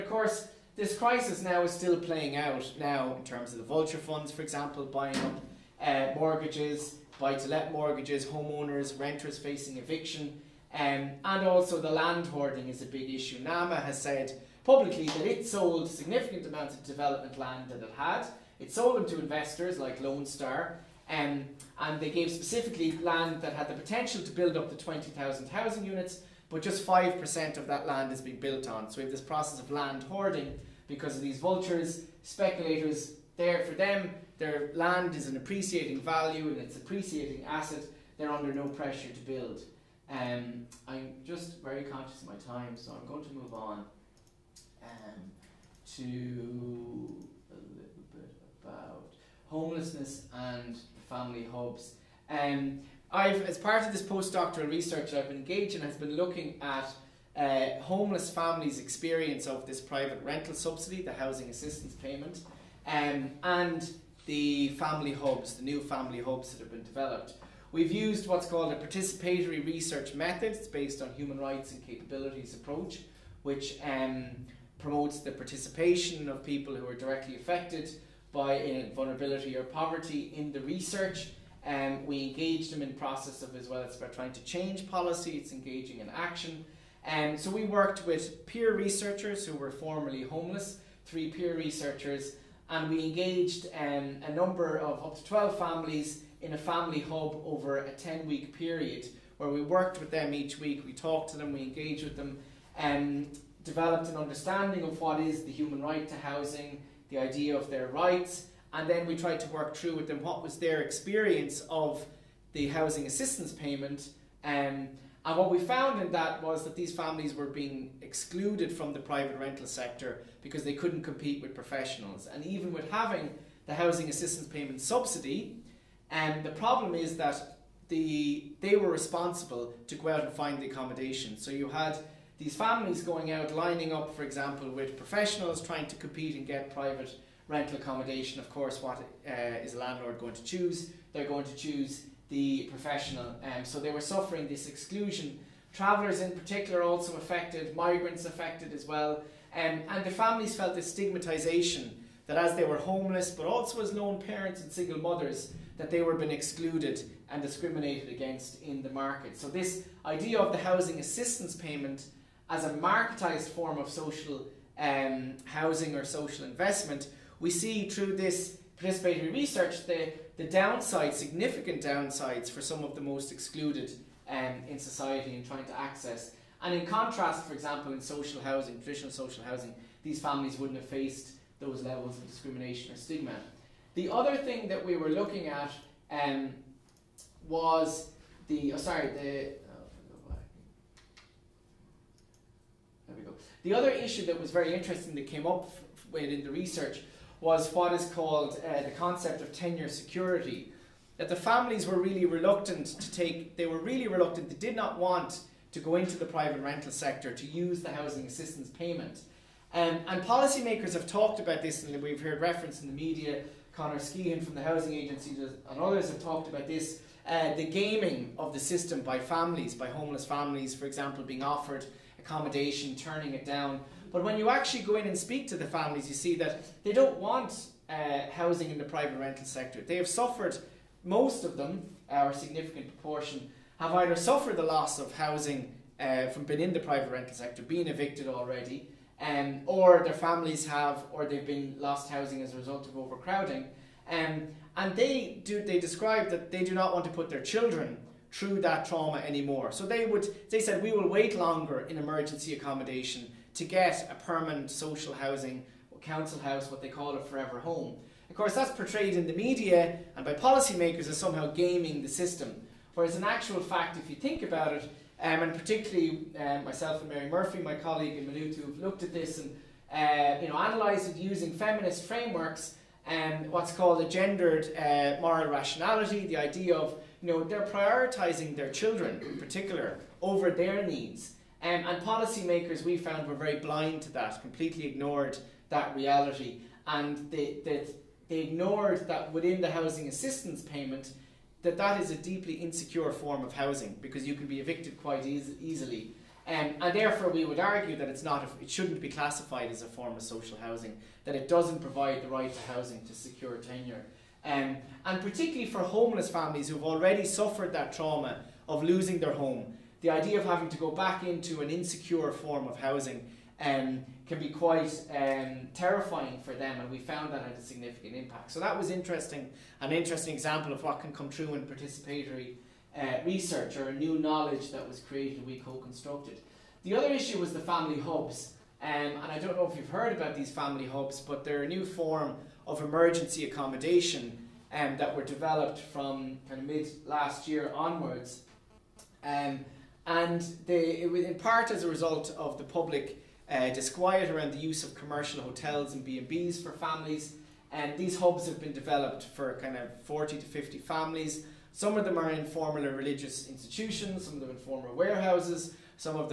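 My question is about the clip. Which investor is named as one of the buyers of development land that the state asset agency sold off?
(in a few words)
Lone Star.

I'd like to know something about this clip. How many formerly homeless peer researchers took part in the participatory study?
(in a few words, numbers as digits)
3.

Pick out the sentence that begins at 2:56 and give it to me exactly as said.
And in contrast, for example, in social housing, traditional social housing, these families wouldn't have faced those levels of discrimination or stigma.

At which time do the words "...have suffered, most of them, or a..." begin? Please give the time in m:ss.
3:49.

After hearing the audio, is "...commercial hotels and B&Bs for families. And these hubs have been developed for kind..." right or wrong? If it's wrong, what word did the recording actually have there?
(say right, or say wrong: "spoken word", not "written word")
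right.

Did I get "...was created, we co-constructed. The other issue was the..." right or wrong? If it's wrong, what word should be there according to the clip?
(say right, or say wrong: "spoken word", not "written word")
right.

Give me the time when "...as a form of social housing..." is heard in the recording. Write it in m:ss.
4:59.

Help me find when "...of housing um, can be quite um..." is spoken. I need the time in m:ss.
5:12.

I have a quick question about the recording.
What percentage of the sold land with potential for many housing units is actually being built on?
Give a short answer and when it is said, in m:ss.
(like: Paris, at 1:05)
5%, at 0:26.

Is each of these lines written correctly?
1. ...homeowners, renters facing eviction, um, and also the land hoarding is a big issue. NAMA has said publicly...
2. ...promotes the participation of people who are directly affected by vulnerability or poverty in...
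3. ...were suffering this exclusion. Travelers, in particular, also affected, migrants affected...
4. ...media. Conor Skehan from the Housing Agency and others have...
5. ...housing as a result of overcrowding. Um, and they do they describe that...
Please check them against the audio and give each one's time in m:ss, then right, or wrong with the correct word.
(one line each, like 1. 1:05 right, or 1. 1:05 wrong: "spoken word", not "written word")
1. 0:08 right
2. 1:14 right
3. 2:23 right
4. 3:32 right
5. 4:02 right.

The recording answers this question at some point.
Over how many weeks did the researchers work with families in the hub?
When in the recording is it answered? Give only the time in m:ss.
1:37.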